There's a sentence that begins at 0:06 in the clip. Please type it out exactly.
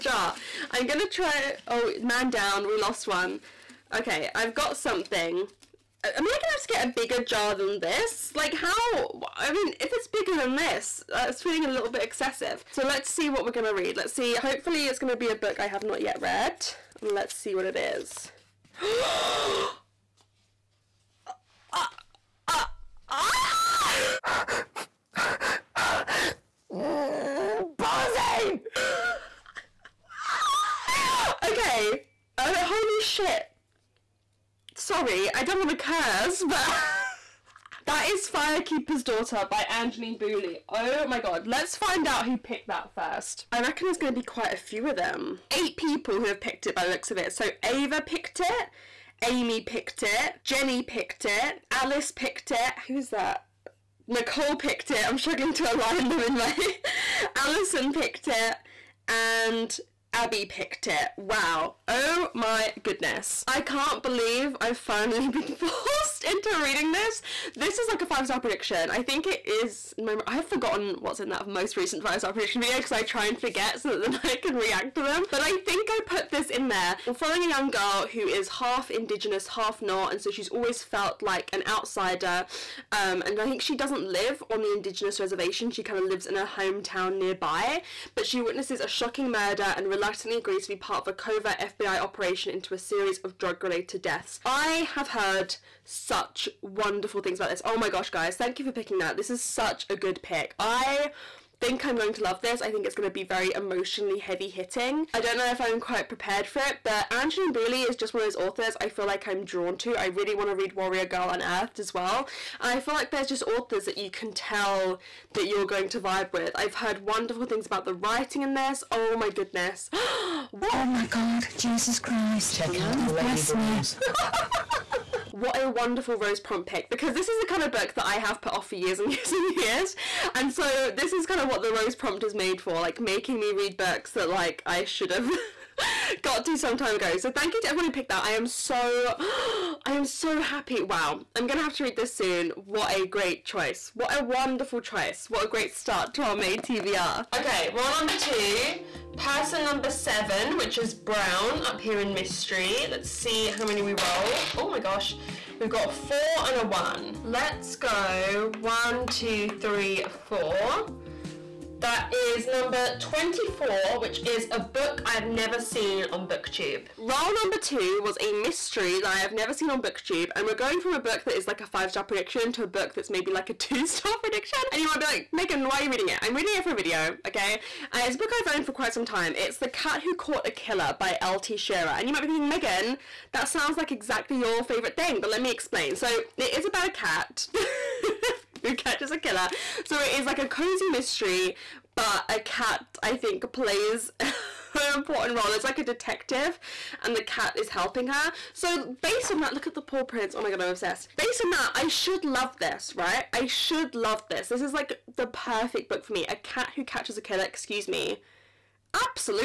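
Am I gonna have to get a bigger jar than this?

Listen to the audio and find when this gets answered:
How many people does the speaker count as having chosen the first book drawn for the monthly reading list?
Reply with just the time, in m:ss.
0:45.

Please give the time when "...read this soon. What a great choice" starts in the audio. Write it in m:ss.
2:21.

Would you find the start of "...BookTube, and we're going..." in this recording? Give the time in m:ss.
2:49.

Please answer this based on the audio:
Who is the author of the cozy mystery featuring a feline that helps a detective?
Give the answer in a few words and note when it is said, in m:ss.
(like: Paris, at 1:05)
L.T. Shearer, at 3:01.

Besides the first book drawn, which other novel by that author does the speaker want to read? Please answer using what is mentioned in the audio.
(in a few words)
Warrior Girl Unearthed.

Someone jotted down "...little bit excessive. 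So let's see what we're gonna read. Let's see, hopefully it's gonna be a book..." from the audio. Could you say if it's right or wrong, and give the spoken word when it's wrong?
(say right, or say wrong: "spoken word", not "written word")
right.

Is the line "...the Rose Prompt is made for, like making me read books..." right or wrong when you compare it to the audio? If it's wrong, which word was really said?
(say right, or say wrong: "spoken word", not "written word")
right.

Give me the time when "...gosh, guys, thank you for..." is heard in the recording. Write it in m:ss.
1:37.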